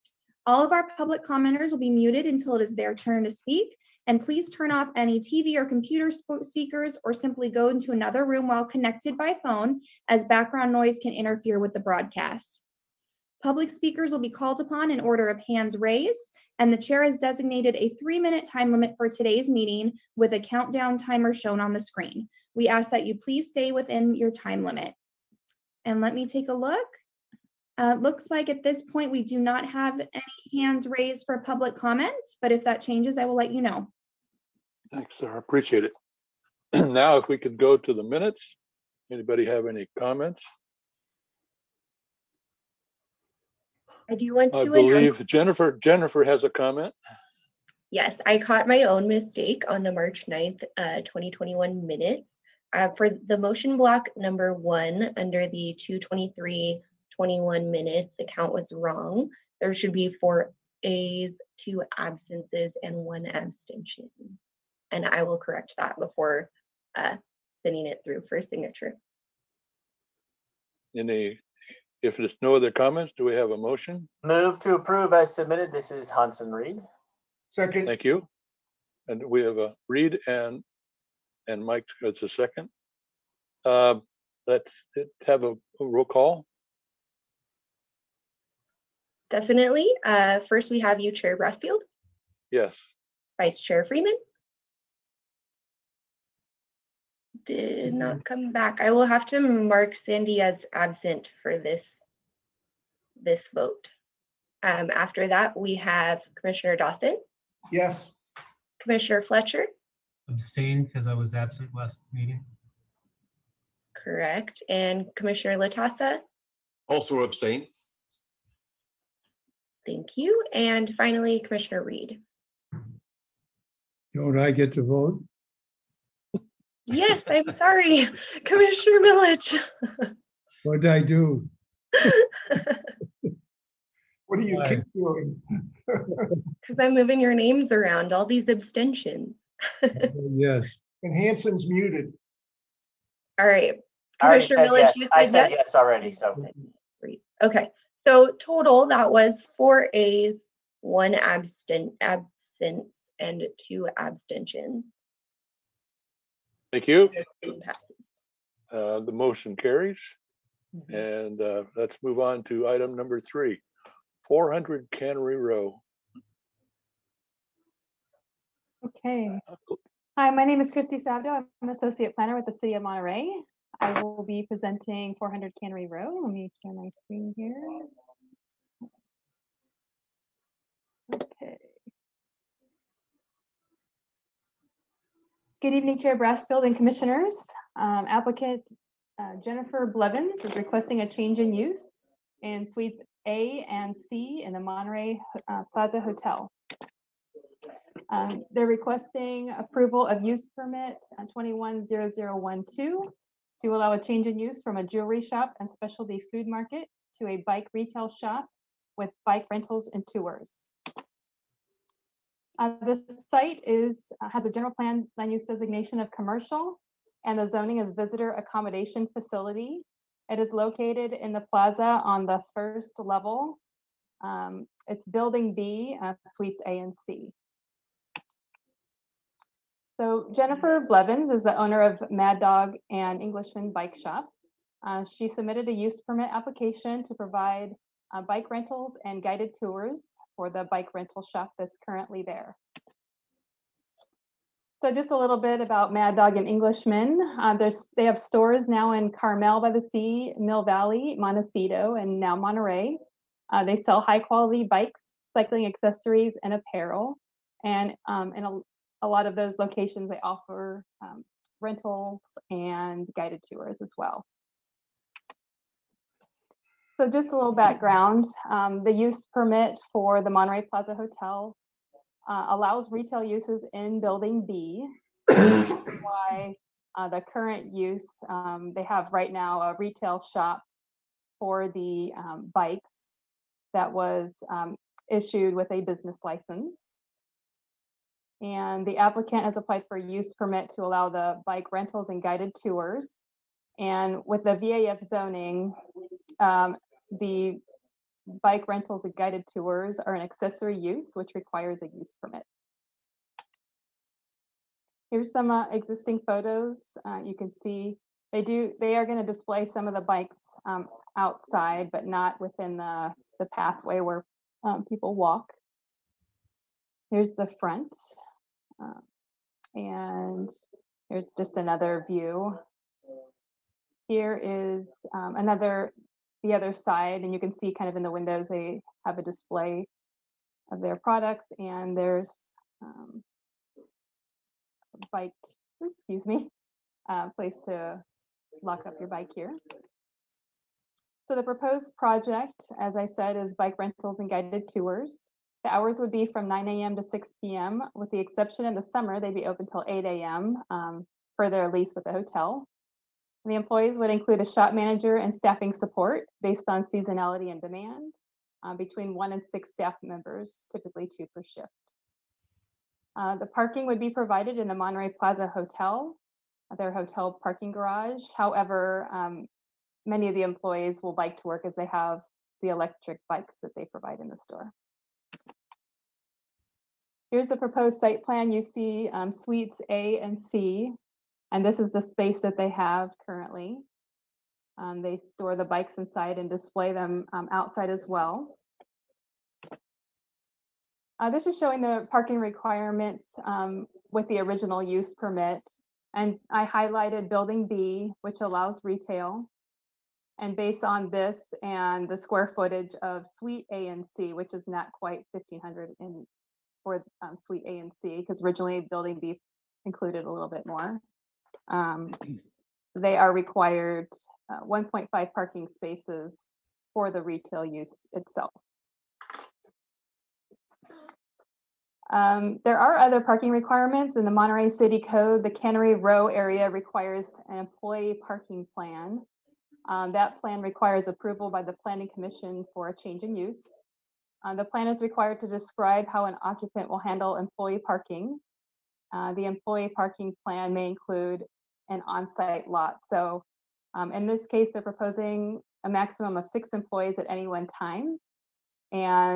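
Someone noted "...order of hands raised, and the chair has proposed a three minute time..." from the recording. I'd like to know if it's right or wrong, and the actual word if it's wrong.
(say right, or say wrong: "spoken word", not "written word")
wrong: "designated", not "proposed".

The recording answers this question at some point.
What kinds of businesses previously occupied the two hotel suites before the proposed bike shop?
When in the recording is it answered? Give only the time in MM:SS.
03:24.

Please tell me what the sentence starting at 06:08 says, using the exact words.
However, um, many of the employees will bike to work as they have the electric bikes that they provide in the store.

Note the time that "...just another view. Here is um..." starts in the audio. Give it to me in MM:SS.
05:21.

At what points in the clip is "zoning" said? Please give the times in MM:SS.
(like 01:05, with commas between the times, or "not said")
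03:37, 04:55.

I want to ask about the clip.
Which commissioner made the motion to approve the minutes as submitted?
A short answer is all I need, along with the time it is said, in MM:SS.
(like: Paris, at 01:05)
Hanson Reed, at 01:16.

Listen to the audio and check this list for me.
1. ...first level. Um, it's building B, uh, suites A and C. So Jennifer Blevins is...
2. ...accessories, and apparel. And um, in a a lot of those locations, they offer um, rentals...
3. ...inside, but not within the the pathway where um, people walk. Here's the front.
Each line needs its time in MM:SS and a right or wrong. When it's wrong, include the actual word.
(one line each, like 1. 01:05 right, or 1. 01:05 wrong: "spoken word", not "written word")
1. 03:42 right
2. 04:15 right
3. 05:11 wrong: "outside", not "inside".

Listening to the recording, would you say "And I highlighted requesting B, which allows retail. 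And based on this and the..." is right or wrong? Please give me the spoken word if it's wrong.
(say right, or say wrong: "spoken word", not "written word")
wrong: "building", not "requesting".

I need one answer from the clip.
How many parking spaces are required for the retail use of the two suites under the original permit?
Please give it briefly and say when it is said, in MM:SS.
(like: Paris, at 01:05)
1.5, at 06:54.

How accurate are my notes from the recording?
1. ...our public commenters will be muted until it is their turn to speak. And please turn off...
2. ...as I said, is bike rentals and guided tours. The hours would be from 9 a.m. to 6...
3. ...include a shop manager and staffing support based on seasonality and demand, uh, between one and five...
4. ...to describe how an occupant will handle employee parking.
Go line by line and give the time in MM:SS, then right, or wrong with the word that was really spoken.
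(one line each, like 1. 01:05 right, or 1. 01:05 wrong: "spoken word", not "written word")
1. 00:00 right
2. 05:42 right
3. 05:54 wrong: "six", not "five"
4. 07:15 right.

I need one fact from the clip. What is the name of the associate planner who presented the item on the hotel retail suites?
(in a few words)
Christy Sabdo.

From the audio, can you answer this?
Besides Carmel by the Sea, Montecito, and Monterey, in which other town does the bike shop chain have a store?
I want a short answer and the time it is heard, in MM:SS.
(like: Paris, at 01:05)
Mill Valley, at 04:10.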